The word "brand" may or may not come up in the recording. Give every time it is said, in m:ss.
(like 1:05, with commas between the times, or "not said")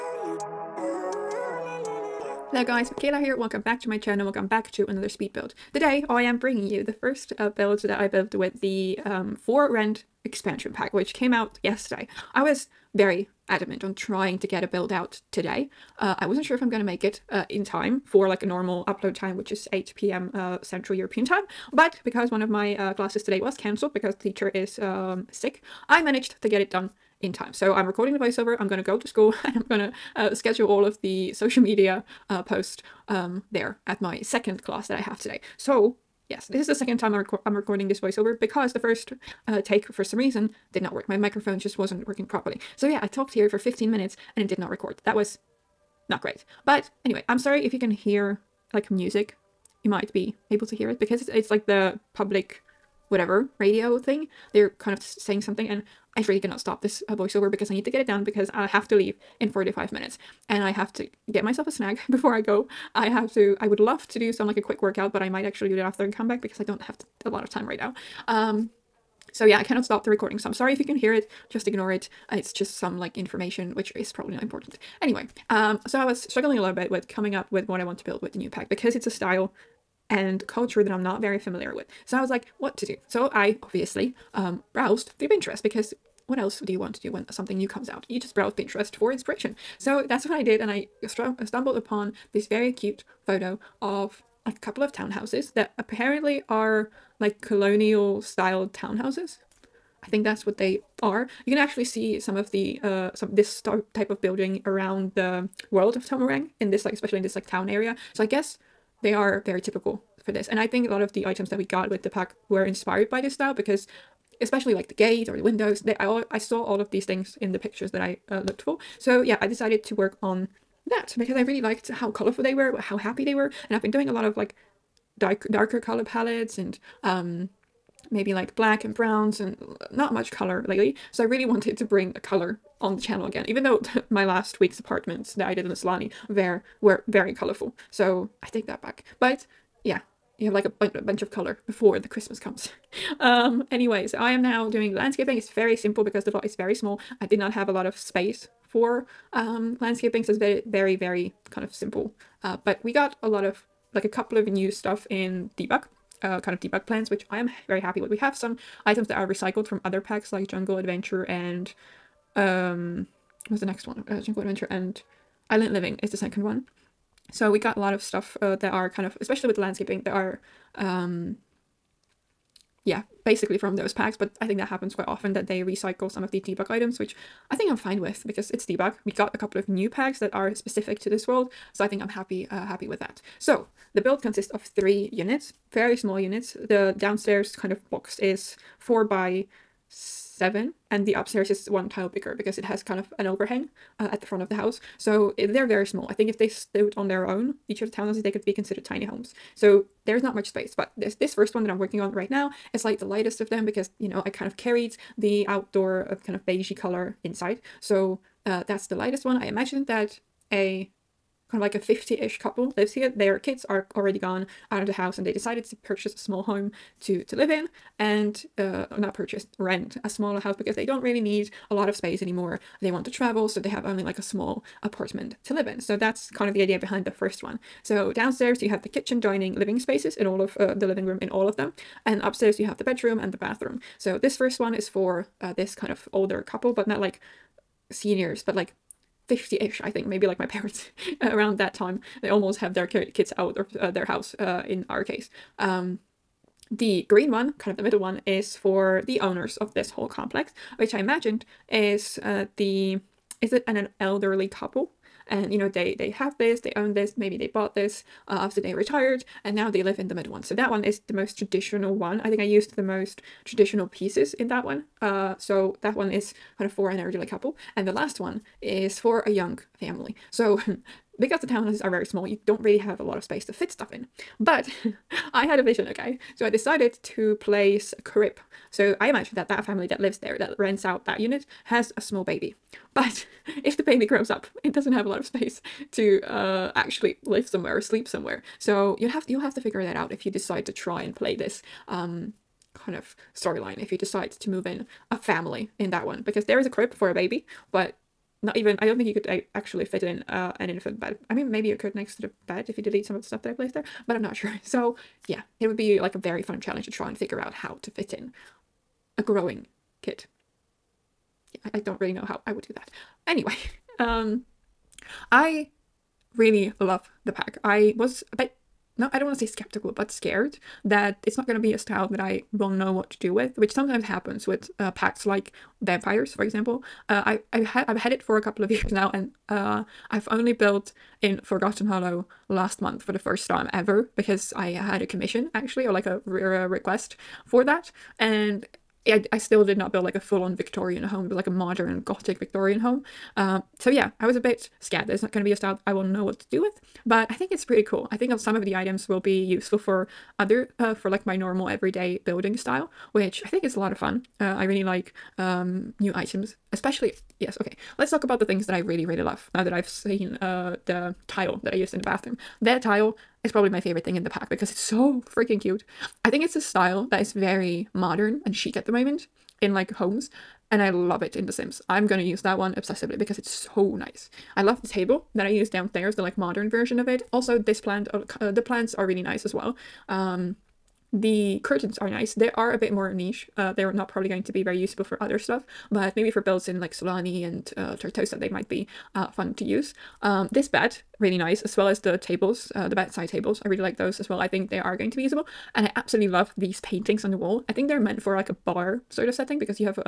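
not said.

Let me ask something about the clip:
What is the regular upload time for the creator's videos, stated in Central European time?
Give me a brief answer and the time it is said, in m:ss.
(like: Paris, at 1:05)
8 p.m., at 0:19.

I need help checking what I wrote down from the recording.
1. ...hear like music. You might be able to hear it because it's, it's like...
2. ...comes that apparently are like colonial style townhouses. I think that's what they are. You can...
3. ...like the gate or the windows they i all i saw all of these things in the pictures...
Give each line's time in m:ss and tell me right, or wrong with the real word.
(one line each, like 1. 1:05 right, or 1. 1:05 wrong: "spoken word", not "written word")
1. 0:47 right
2. 1:34 wrong: "townhouses", not "comes"
3. 1:54 right.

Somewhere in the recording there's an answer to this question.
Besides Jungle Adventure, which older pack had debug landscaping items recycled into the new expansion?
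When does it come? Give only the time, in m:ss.
2:45.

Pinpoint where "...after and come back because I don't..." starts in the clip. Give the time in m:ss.
1:05.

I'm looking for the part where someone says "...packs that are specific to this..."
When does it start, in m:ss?
2:59.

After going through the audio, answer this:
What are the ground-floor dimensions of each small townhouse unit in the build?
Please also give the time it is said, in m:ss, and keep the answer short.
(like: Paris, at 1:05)
4 by 7, at 3:08.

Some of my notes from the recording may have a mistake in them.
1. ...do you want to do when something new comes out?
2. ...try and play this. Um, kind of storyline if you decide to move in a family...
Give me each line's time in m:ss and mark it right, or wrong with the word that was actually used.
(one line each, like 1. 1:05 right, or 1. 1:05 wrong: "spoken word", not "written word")
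1. 1:26 right
2. 4:50 right.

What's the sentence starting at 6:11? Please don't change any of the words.
I'm gonna use that one obsessively because it's so nice.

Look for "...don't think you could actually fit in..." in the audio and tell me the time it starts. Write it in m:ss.
4:58.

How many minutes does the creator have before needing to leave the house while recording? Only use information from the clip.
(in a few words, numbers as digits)
45.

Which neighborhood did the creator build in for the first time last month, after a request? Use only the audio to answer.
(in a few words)
Forgotten Hollow.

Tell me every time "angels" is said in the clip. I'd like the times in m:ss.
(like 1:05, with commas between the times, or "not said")
not said.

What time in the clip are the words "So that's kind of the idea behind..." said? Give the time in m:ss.
3:45.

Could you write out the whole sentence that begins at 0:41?
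My microphone just wasn't working properly.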